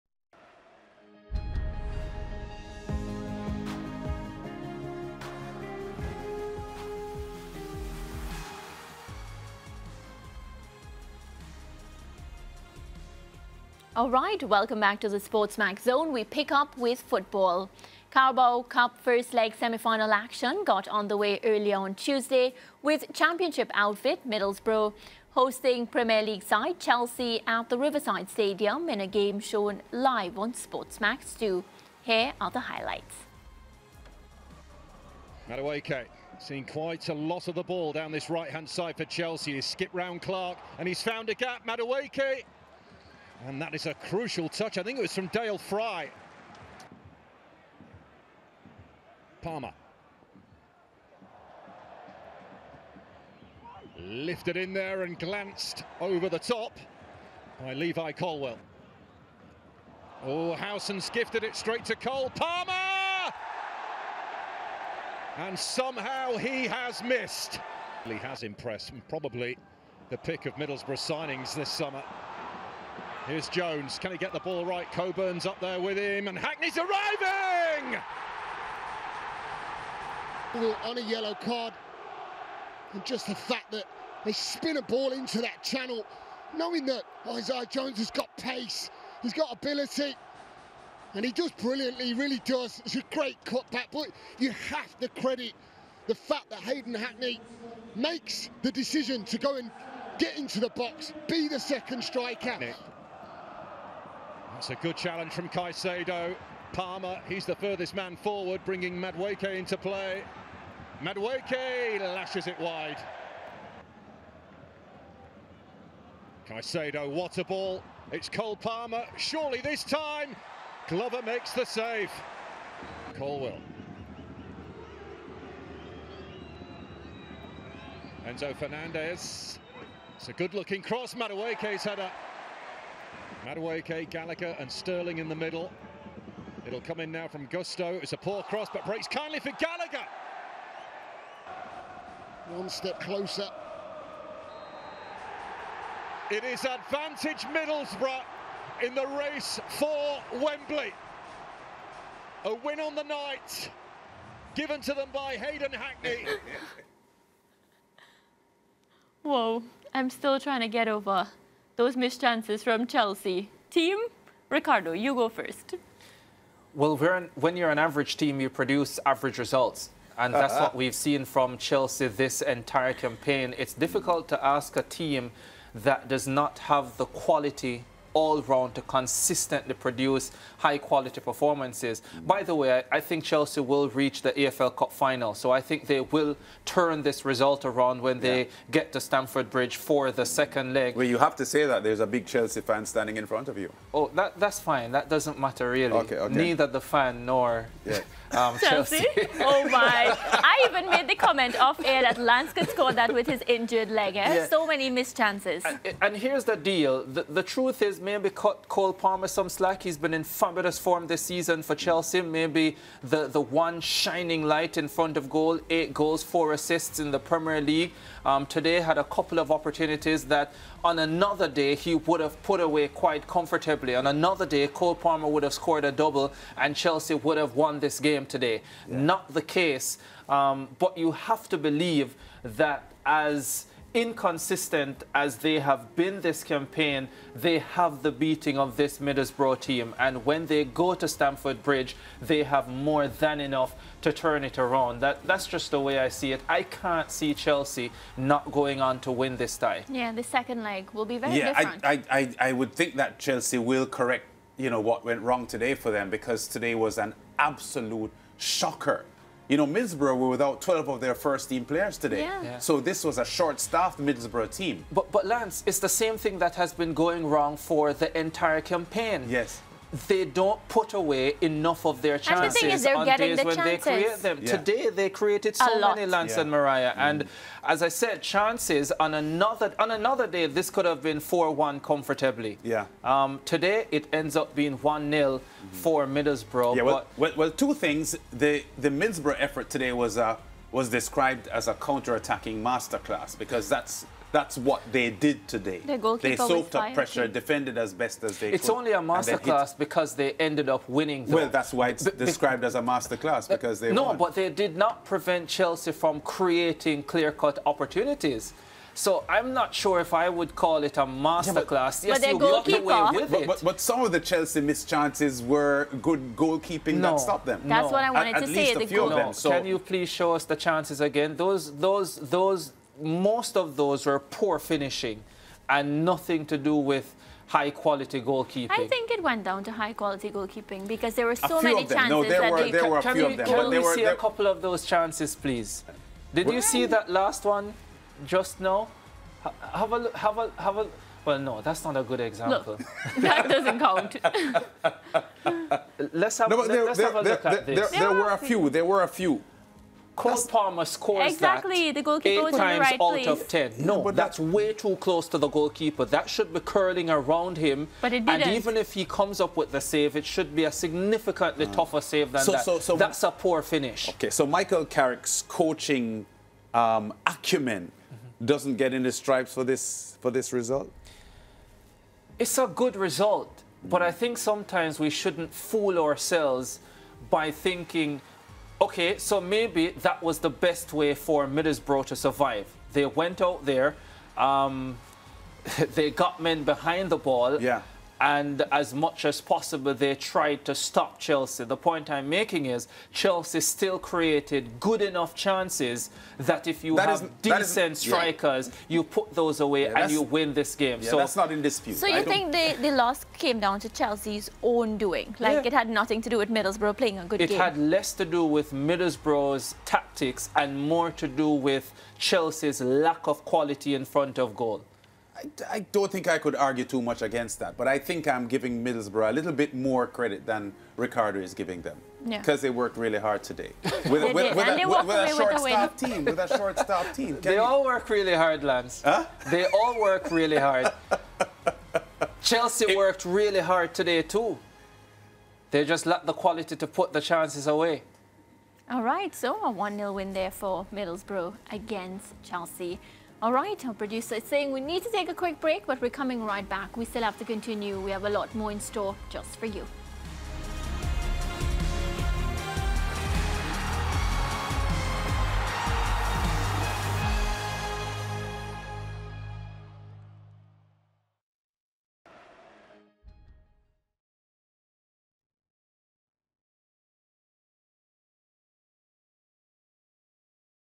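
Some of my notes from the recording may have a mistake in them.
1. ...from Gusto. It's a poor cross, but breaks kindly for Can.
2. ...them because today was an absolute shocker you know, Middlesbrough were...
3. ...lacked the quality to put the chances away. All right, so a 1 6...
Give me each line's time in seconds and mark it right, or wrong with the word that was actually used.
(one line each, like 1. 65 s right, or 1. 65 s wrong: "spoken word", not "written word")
1. 137 s wrong: "Gallagher", not "Can"
2. 255 s right
3. 436 s wrong: "0", not "6".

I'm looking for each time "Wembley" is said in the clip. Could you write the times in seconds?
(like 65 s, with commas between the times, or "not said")
150 s.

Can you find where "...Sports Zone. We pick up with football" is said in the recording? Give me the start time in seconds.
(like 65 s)
15 s.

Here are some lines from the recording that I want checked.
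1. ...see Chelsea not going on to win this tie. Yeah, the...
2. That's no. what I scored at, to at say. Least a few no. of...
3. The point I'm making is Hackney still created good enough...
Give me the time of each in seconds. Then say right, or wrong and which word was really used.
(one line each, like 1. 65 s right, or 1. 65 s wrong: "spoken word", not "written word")
1. 247 s right
2. 317 s wrong: "wanted", not "scored"
3. 391 s wrong: "Chelsea", not "Hackney".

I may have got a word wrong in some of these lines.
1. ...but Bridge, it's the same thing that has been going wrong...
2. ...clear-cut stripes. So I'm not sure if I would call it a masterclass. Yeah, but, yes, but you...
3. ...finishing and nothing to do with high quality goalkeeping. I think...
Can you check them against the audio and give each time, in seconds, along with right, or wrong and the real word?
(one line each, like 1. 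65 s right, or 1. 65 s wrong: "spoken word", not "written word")
1. 265 s wrong: "Lance", not "Bridge"
2. 307 s wrong: "opportunities", not "stripes"
3. 324 s right.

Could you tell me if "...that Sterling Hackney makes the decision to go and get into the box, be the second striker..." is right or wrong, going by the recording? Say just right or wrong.
wrong.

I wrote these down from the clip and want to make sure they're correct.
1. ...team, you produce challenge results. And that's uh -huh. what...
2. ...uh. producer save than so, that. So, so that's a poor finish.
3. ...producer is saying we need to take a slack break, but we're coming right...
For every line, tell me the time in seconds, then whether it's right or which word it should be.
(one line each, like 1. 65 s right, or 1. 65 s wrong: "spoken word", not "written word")
1. 168 s wrong: "average", not "challenge"
2. 361 s wrong: "tougher", not "producer"
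3. 443 s wrong: "quick", not "slack".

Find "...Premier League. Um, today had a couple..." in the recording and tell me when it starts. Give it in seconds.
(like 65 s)
217 s.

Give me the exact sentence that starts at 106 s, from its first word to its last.
Palmer, he's the furthest man forward, bringing Madueke into play.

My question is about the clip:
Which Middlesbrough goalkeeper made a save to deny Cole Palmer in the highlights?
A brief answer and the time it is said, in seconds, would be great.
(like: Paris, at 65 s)
Glover, at 120 s.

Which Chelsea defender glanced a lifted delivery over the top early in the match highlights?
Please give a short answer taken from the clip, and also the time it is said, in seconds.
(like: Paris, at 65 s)
Levi Colwill, at 57 s.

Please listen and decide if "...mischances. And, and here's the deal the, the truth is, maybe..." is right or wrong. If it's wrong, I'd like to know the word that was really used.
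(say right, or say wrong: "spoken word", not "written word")
wrong: "chances", not "mischances".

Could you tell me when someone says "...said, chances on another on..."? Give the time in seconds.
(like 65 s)
277 s.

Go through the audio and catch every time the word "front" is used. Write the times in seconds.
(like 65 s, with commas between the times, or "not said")
193 s, 214 s, 414 s.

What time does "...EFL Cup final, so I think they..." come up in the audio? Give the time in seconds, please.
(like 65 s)
184 s.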